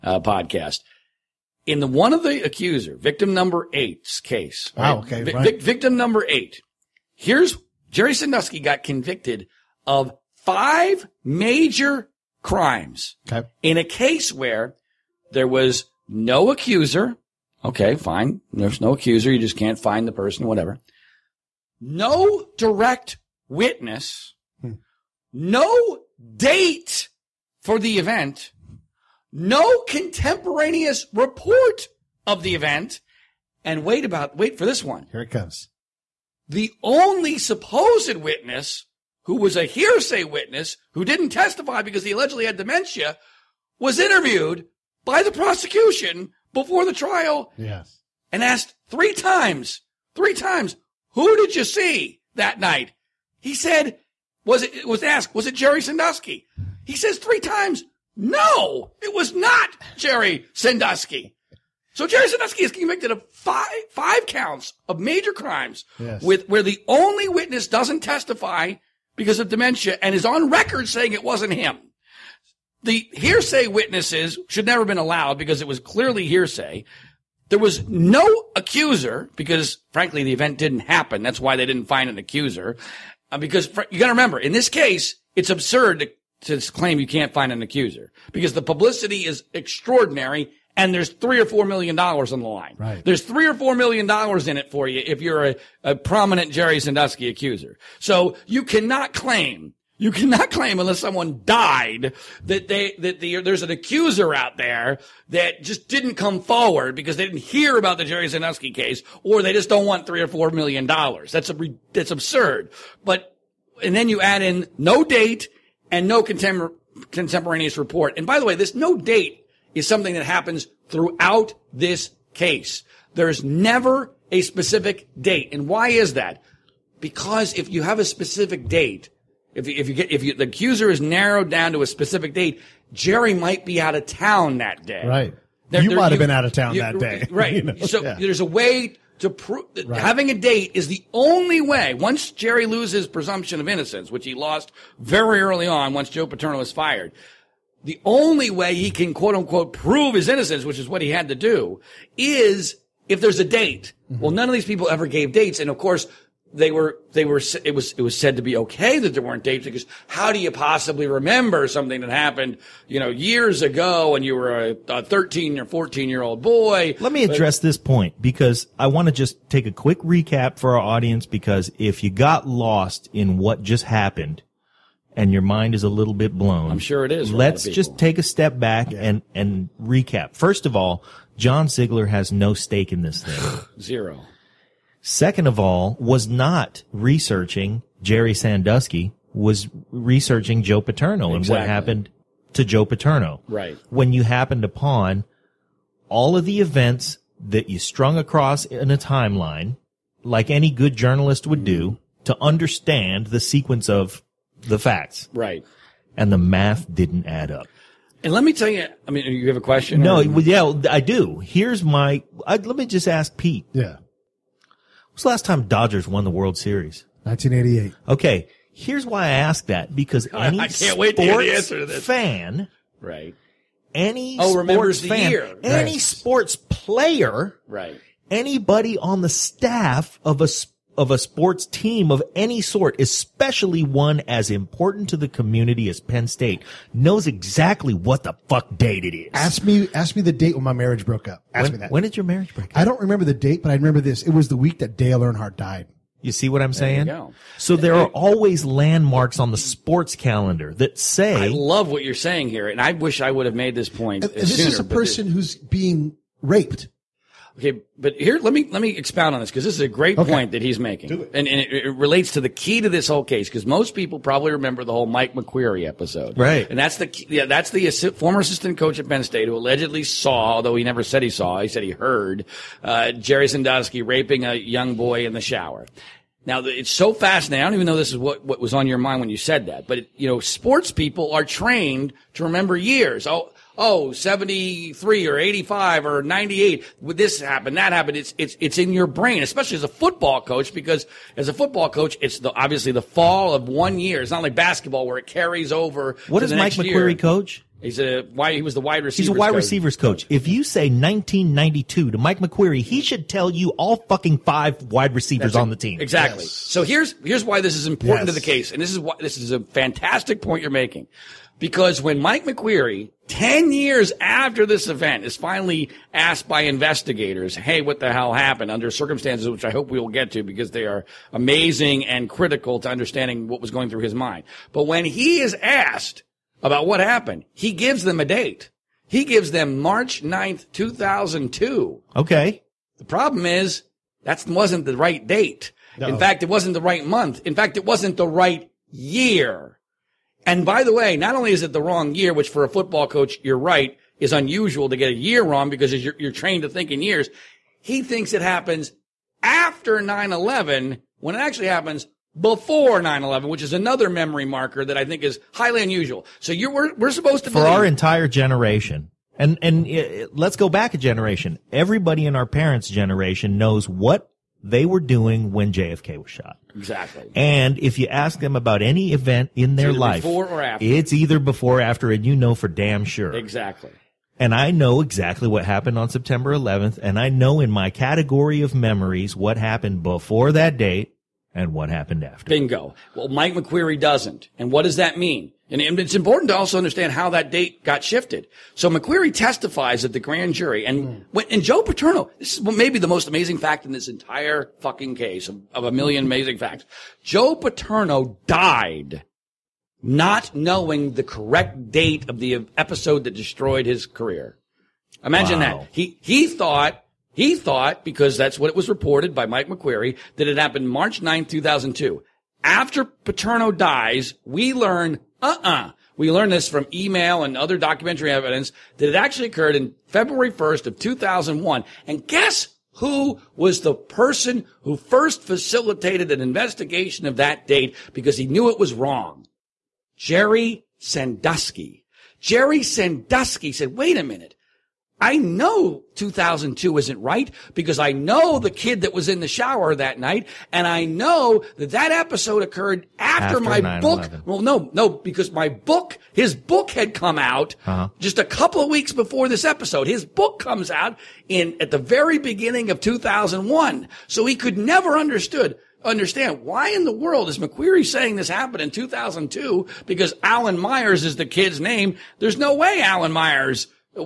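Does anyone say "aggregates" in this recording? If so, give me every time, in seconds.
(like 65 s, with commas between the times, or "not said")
not said.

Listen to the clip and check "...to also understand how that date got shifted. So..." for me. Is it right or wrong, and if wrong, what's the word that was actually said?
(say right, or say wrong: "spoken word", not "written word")
right.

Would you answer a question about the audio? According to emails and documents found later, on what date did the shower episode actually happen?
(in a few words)
February 1st, 2001.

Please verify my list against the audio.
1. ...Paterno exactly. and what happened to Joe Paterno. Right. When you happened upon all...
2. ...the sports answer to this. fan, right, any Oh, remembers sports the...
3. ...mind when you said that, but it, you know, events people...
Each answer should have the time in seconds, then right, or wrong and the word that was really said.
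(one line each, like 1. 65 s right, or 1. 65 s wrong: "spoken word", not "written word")
1. 190 s right
2. 221 s right
3. 278 s wrong: "sports", not "events".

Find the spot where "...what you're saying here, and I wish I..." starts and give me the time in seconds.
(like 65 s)
251 s.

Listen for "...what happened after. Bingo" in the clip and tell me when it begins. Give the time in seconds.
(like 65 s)
381 s.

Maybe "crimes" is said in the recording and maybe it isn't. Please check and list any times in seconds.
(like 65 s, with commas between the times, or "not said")
12 s, 65 s.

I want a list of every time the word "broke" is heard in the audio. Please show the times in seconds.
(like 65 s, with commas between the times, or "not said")
241 s.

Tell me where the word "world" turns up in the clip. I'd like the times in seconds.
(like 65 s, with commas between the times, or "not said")
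216 s, 457 s.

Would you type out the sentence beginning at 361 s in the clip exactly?
Everybody in our parents' generation knows what they were doing when JFK was shot.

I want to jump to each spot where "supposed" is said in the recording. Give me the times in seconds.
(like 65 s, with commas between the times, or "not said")
37 s, 357 s.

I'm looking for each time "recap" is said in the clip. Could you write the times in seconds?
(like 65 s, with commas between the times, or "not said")
169 s, 179 s.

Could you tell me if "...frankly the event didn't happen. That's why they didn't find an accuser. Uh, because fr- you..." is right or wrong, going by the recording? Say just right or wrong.
right.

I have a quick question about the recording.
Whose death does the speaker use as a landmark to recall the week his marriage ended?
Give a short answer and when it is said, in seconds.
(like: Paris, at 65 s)
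Dale Earnhardt, at 244 s.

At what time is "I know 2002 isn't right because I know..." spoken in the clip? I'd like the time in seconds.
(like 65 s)
435 s.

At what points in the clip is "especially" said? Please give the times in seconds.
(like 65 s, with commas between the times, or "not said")
233 s, 289 s.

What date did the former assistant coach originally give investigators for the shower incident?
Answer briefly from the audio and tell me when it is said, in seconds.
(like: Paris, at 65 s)
March 9th, 2002, at 329 s.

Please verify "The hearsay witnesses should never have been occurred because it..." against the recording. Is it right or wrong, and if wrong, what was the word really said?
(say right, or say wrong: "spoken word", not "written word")
wrong: "allowed", not "occurred".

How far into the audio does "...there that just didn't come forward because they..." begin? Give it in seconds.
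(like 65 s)
104 s.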